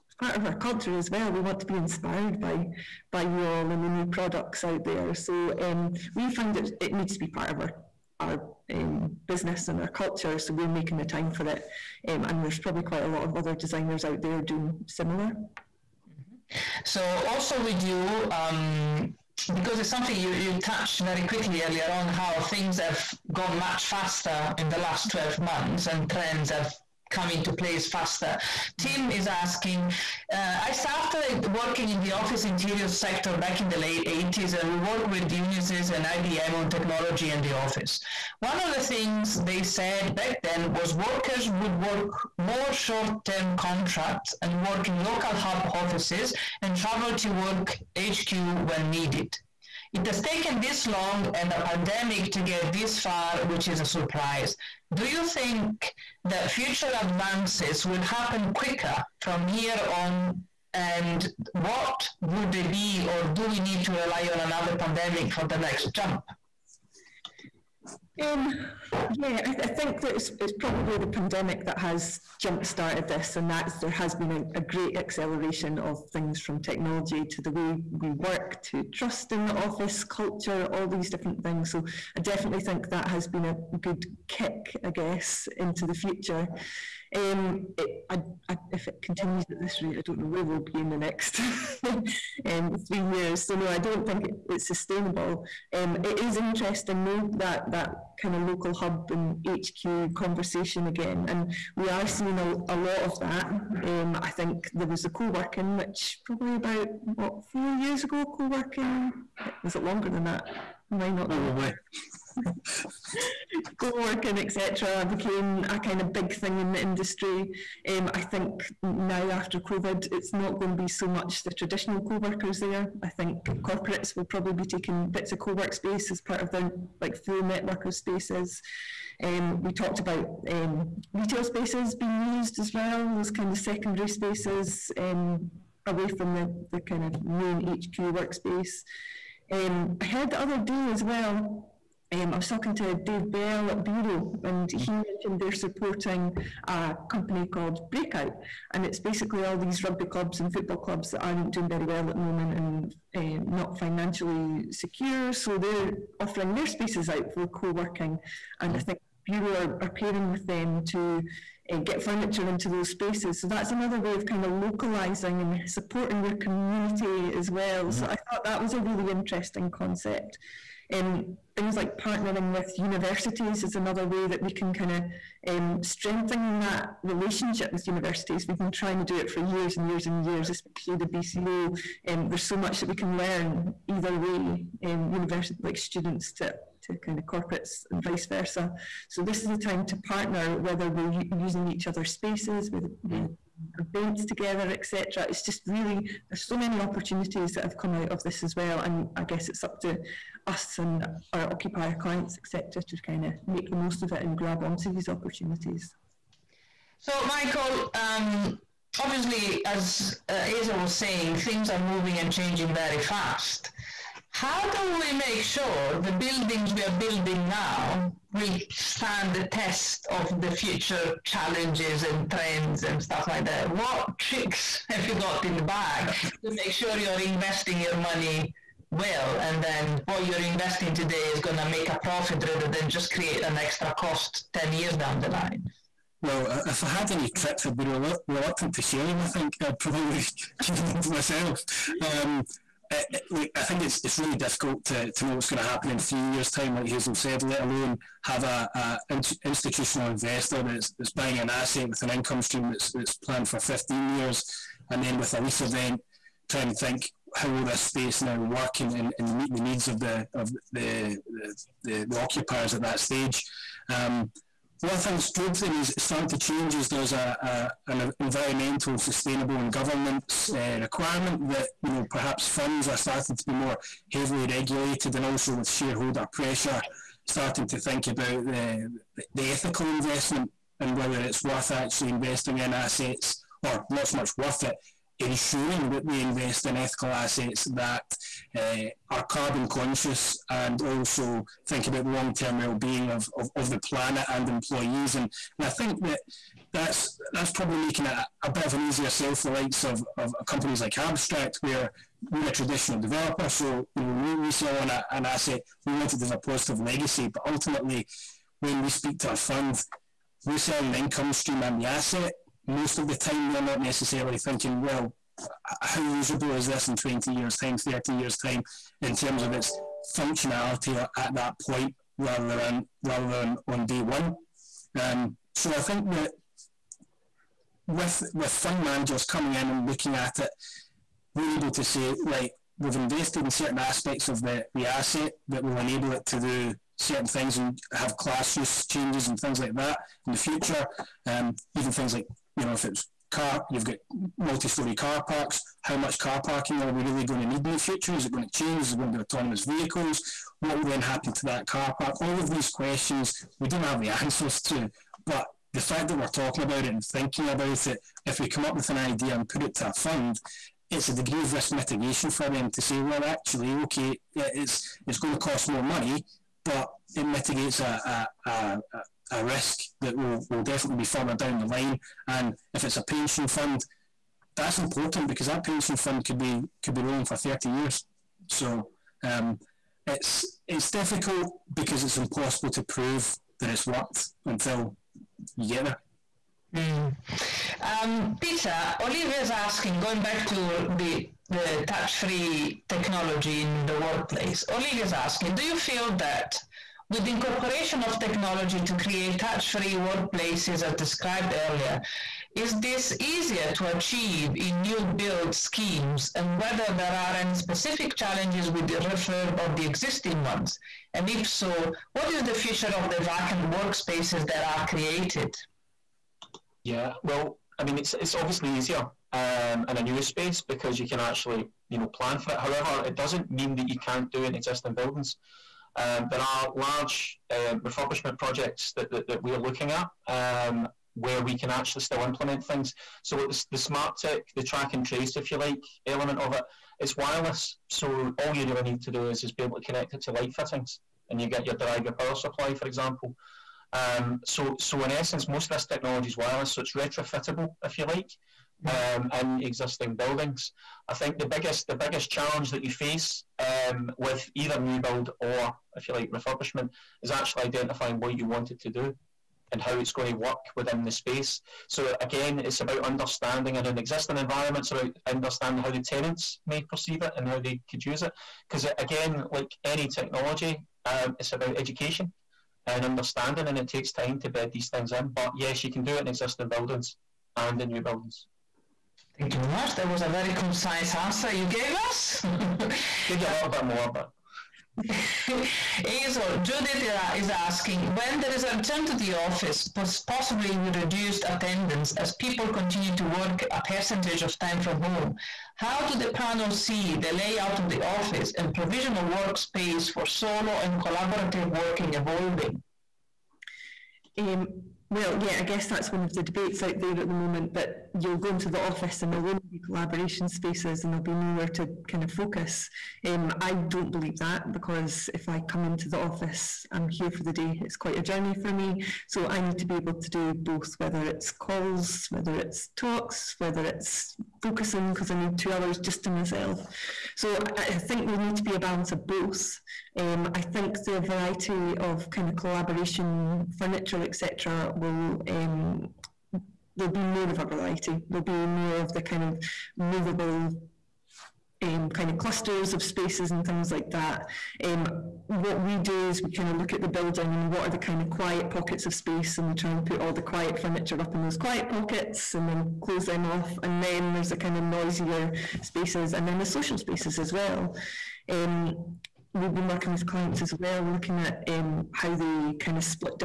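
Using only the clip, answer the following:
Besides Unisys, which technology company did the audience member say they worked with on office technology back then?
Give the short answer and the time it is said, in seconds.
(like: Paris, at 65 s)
IBM, at 36 s.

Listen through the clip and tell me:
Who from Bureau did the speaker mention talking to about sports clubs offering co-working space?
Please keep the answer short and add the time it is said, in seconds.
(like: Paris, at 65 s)
Dave Bell, at 142 s.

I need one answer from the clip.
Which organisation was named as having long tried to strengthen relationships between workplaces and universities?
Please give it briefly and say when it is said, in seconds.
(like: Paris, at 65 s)
BCO, at 181 s.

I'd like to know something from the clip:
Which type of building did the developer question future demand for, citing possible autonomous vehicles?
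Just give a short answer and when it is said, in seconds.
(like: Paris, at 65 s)
multi-story car parks, at 344 s.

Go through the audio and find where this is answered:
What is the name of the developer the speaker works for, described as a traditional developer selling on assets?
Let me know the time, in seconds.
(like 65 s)
300 s.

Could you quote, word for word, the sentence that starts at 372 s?
And if it's a pension fund, that's important because that pension fund could be could be rolling for 30 years.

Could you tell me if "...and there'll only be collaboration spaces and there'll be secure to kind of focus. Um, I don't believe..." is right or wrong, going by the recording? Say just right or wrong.
wrong.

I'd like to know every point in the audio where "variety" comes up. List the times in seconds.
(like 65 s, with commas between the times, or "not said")
531 s, 537 s.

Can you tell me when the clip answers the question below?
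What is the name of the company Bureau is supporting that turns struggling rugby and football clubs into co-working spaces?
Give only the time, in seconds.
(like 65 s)
147 s.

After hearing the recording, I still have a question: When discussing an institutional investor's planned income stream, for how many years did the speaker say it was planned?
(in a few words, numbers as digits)
15 years.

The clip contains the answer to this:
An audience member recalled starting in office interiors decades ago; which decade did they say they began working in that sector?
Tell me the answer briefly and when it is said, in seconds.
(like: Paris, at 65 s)
late 80s, at 33 s.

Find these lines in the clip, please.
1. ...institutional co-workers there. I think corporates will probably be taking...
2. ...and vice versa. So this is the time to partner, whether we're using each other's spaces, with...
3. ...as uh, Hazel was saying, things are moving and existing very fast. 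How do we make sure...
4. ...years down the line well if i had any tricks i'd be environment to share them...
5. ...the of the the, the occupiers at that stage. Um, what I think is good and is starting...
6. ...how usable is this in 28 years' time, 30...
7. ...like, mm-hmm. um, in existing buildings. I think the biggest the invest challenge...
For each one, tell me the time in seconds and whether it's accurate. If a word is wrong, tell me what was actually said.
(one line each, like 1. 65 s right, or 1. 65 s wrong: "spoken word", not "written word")
1. 121 s wrong: "traditional", not "institutional"
2. 187 s right
3. 209 s wrong: "changing", not "existing"
4. 234 s wrong: "reluctant", not "environment"
5. 259 s right
6. 315 s wrong: "20", not "28"
7. 448 s wrong: "biggest", not "invest".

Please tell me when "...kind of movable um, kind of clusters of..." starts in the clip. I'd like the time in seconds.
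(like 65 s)
539 s.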